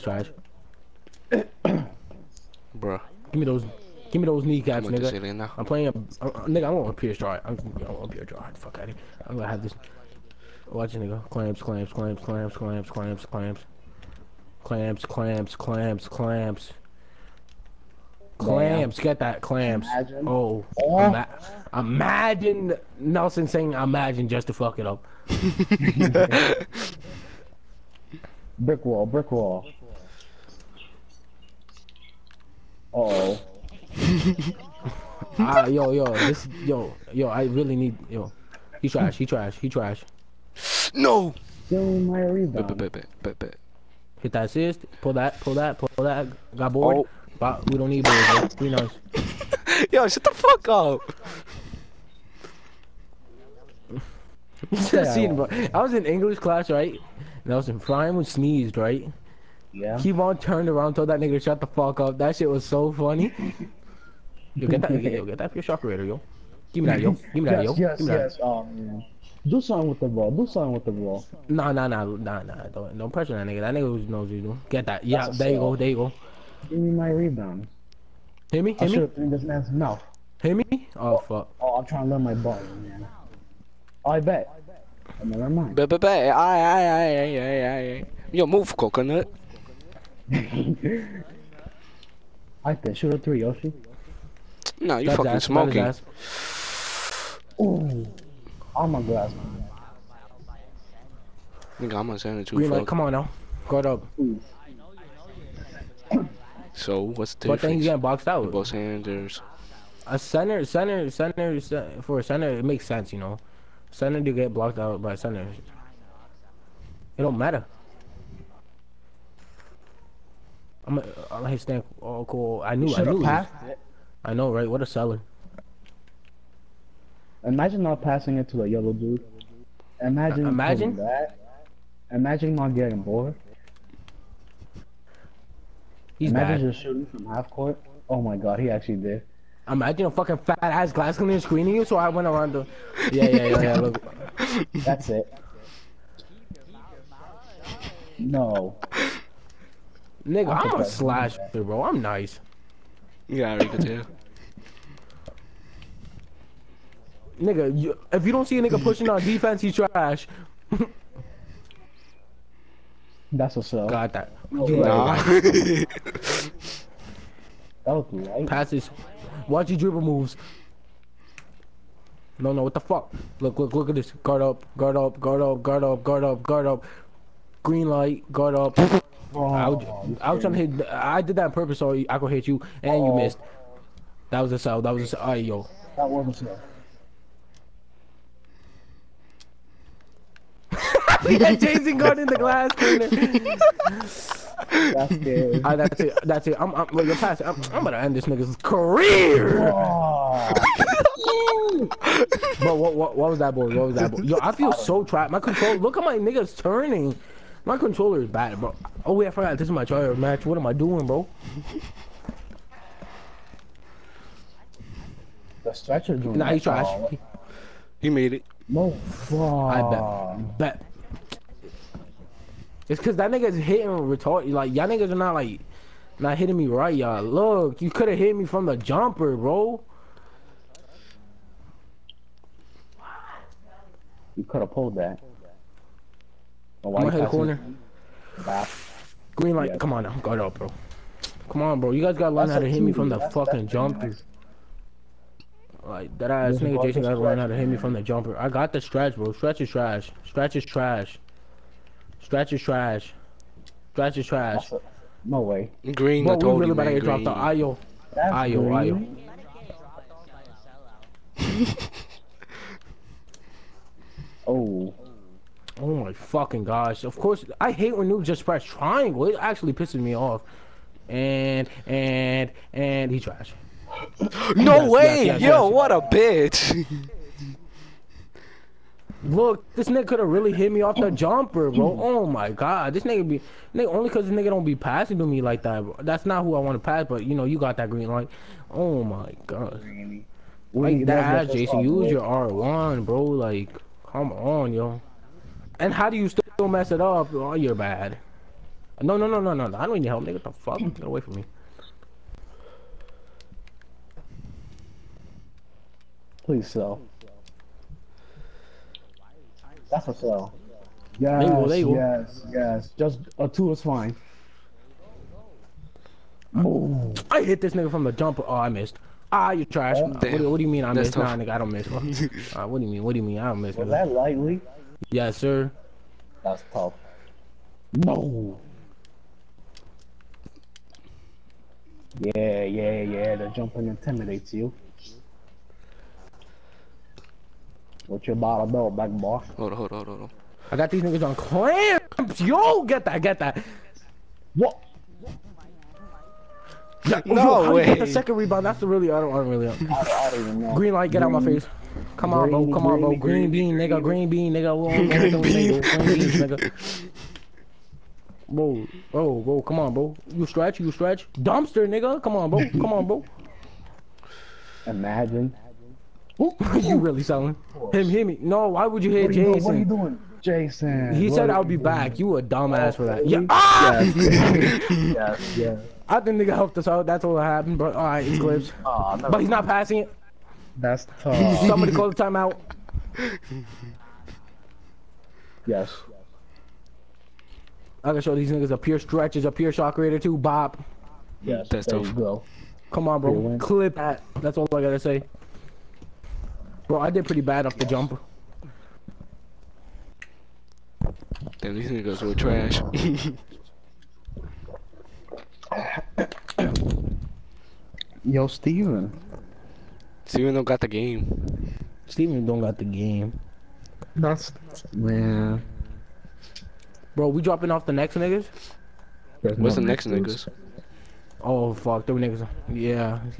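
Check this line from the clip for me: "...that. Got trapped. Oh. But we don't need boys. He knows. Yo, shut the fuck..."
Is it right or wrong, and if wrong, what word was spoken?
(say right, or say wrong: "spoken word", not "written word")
wrong: "bored", not "trapped".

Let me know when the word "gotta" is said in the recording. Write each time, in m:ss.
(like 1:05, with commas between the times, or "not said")
4:02, 4:07, 6:28, 6:34.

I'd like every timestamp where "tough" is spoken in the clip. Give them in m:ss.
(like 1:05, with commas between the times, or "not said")
5:26, 6:21, 6:31.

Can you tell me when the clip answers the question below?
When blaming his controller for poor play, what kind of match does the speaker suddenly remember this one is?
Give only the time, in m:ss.
3:29.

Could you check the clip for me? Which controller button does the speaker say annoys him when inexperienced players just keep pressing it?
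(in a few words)
Triangle.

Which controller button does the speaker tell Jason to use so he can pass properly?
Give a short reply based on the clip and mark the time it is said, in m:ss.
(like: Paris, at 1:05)
R1, at 4:52.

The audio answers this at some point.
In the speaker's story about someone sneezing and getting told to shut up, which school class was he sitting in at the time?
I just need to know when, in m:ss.
0:56.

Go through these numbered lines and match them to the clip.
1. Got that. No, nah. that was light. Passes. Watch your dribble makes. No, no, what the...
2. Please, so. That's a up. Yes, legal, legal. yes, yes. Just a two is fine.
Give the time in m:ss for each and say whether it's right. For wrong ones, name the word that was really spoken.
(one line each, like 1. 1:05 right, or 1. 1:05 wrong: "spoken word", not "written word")
1. 2:43 wrong: "moves", not "makes"
2. 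5:06 right.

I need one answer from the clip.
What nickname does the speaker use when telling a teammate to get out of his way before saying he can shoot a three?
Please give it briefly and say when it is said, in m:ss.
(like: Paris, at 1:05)
Coconut, at 1:28.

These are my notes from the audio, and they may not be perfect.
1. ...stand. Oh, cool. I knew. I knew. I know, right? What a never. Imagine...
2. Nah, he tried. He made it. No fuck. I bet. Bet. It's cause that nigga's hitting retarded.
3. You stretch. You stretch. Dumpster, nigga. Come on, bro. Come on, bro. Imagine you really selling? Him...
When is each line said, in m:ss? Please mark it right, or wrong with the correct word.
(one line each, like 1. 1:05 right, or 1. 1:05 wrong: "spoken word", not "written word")
1. 2:01 wrong: "seller", not "never"
2. 3:36 right
3. 6:00 right.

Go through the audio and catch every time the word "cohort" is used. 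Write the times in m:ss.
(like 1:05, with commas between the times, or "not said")
not said.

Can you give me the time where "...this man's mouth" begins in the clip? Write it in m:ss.
1:19.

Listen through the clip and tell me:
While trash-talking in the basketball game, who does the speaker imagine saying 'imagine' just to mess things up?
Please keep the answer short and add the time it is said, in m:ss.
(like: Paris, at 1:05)
Nelson, at 0:22.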